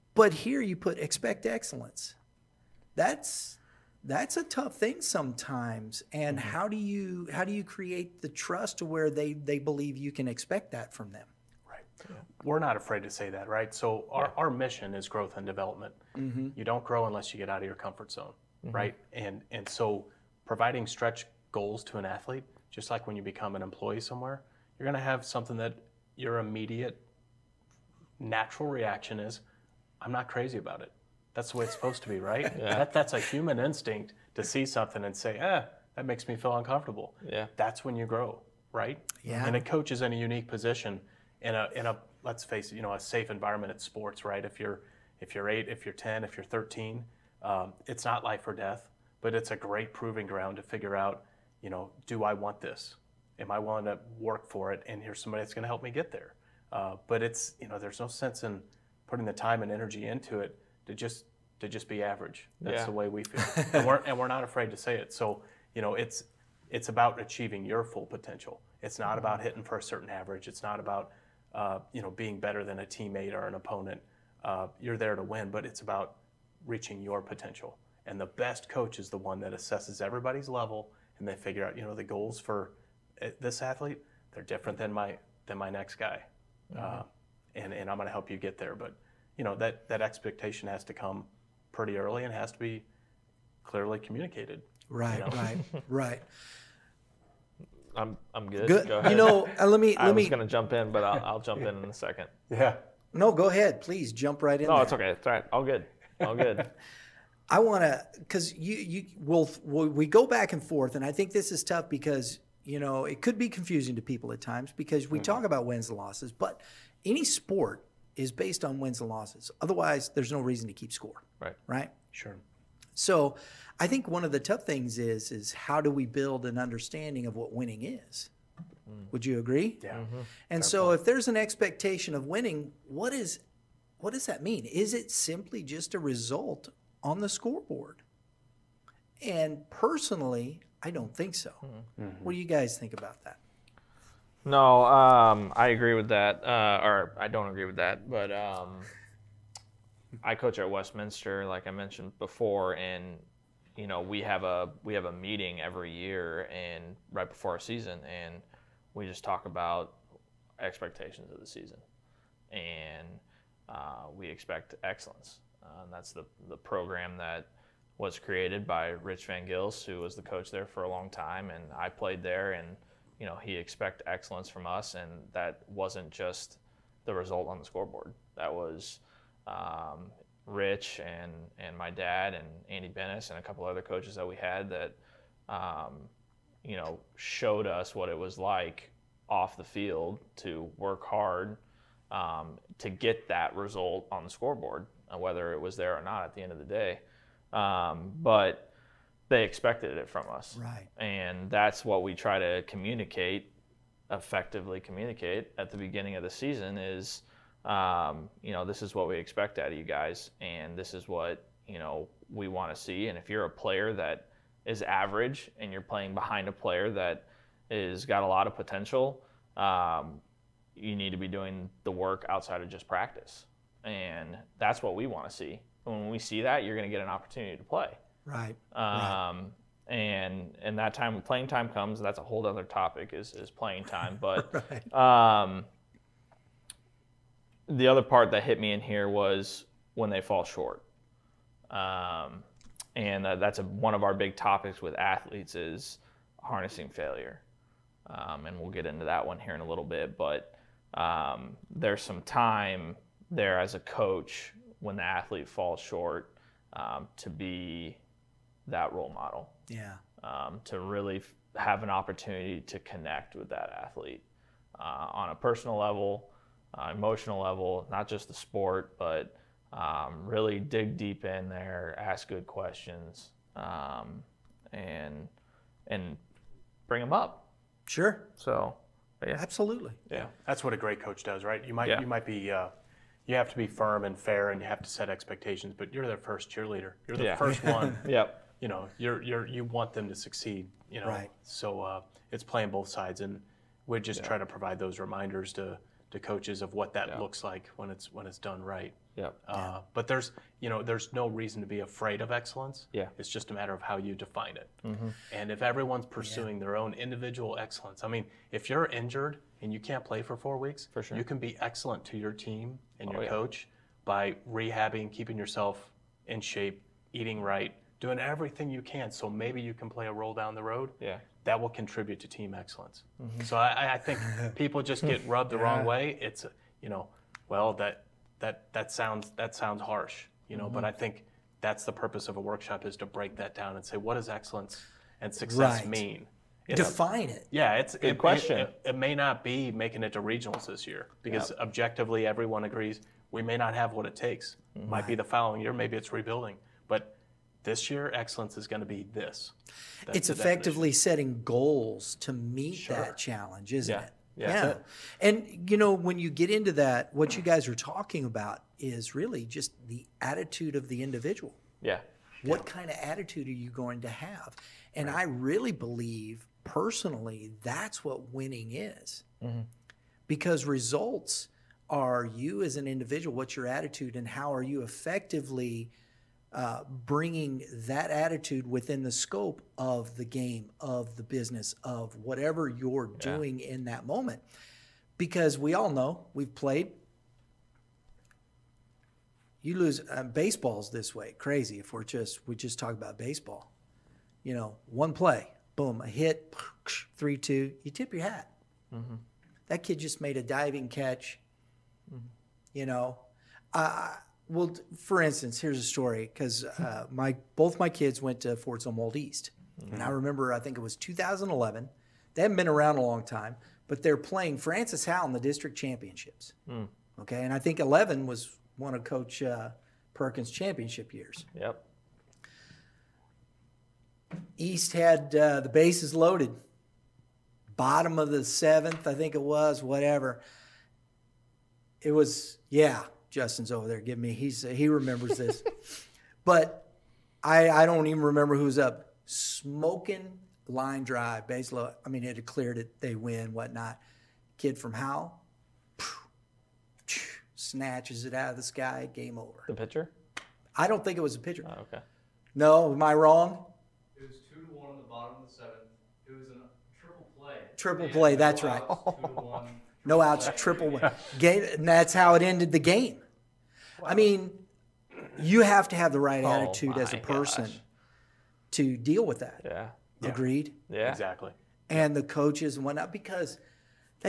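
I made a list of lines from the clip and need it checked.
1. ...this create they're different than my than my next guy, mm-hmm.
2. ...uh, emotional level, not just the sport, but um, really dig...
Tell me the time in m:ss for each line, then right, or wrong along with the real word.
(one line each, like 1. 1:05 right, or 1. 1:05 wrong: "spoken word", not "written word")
1. 1:23 wrong: "athlete", not "create"
2. 4:26 right.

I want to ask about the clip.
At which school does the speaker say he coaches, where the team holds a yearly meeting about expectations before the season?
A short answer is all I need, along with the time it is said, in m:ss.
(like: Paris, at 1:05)
Westminster, at 2:30.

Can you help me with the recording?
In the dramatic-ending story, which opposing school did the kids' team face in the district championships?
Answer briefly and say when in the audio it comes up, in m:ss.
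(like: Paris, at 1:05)
Francis Howell, at 6:54.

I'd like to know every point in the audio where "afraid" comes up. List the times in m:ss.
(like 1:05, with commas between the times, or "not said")
0:12, 1:04, 5:01.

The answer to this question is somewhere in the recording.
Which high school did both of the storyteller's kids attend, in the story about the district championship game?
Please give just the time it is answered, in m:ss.
6:48.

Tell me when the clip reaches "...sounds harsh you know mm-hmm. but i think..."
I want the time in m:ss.
5:29.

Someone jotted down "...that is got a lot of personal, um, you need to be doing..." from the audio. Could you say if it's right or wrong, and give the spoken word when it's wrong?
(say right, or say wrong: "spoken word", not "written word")
wrong: "potential", not "personal".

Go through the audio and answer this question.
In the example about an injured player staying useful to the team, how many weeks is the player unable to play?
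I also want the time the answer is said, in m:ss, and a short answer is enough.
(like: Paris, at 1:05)
4, at 5:10.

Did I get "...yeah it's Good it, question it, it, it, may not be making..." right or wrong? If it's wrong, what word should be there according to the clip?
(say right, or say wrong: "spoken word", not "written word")
right.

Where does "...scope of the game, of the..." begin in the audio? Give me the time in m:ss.
6:19.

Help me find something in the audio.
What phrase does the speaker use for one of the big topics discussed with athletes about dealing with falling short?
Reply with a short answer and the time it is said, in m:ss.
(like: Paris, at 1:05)
harnessing failure, at 4:06.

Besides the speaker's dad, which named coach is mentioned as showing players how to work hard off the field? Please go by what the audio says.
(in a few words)
Andy Bennis.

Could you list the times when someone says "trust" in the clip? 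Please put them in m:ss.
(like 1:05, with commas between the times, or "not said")
0:08.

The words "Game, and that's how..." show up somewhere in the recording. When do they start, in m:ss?
7:41.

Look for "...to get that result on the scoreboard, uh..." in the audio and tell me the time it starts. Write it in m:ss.
3:12.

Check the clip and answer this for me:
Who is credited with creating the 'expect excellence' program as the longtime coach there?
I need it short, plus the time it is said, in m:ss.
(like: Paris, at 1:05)
Rich Van Gils, at 2:48.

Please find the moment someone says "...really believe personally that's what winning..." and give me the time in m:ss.
6:05.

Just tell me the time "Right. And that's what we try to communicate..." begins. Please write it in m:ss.
3:20.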